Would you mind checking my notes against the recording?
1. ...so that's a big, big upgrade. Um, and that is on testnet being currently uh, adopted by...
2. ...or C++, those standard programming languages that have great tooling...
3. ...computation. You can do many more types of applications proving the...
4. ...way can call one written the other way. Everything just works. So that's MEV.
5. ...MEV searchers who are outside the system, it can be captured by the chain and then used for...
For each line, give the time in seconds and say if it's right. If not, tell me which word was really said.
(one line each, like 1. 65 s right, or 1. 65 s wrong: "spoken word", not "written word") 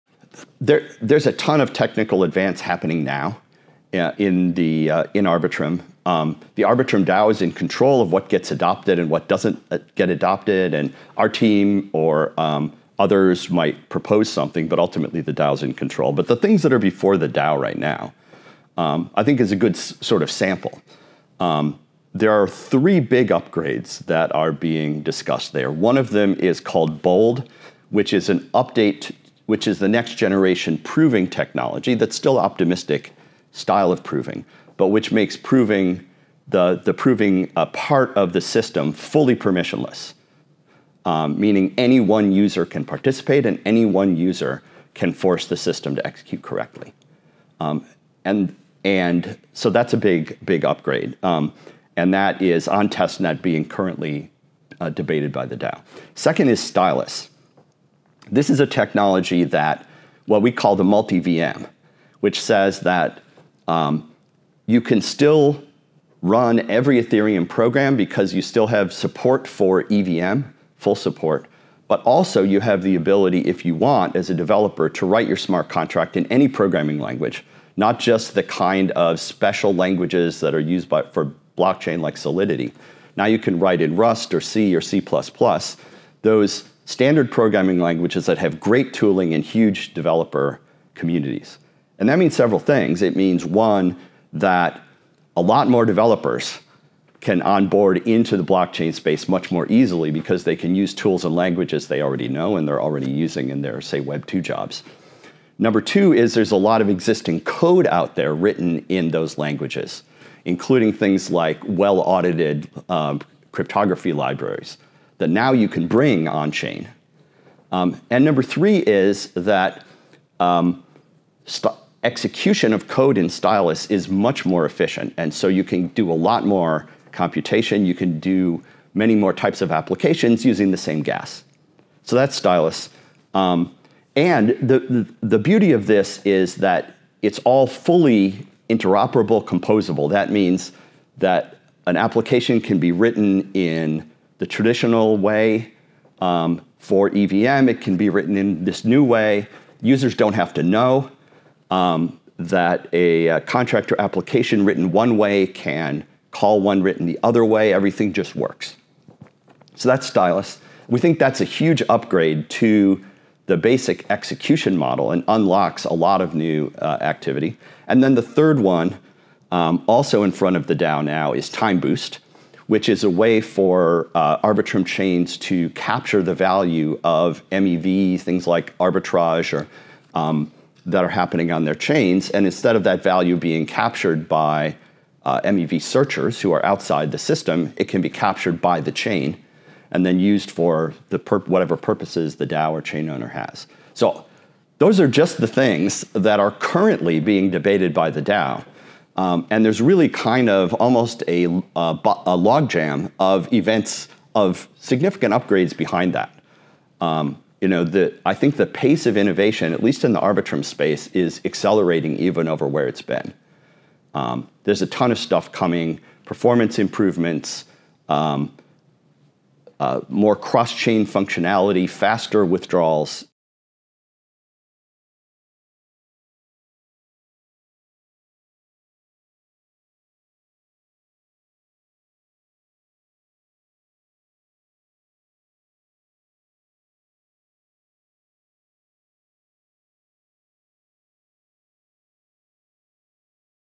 1. 49 s wrong: "debated", not "adopted"
2. 84 s right
3. 127 s wrong: "using", not "proving"
4. 155 s wrong: "Stylus", not "MEV"
5. 185 s right.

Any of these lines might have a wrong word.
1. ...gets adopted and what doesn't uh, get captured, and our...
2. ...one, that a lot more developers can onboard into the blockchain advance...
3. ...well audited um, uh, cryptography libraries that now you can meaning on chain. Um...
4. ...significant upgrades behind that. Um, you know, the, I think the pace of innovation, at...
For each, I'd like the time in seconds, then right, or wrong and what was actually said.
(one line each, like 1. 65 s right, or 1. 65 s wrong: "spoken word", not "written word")
1. 8 s wrong: "adopted", not "captured"
2. 93 s wrong: "space", not "advance"
3. 111 s wrong: "bring", not "meaning"
4. 204 s right.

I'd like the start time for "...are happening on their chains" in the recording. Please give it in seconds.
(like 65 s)
181 s.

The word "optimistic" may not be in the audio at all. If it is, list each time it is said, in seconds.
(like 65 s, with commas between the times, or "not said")
32 s.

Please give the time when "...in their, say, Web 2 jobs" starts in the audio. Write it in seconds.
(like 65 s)
103 s.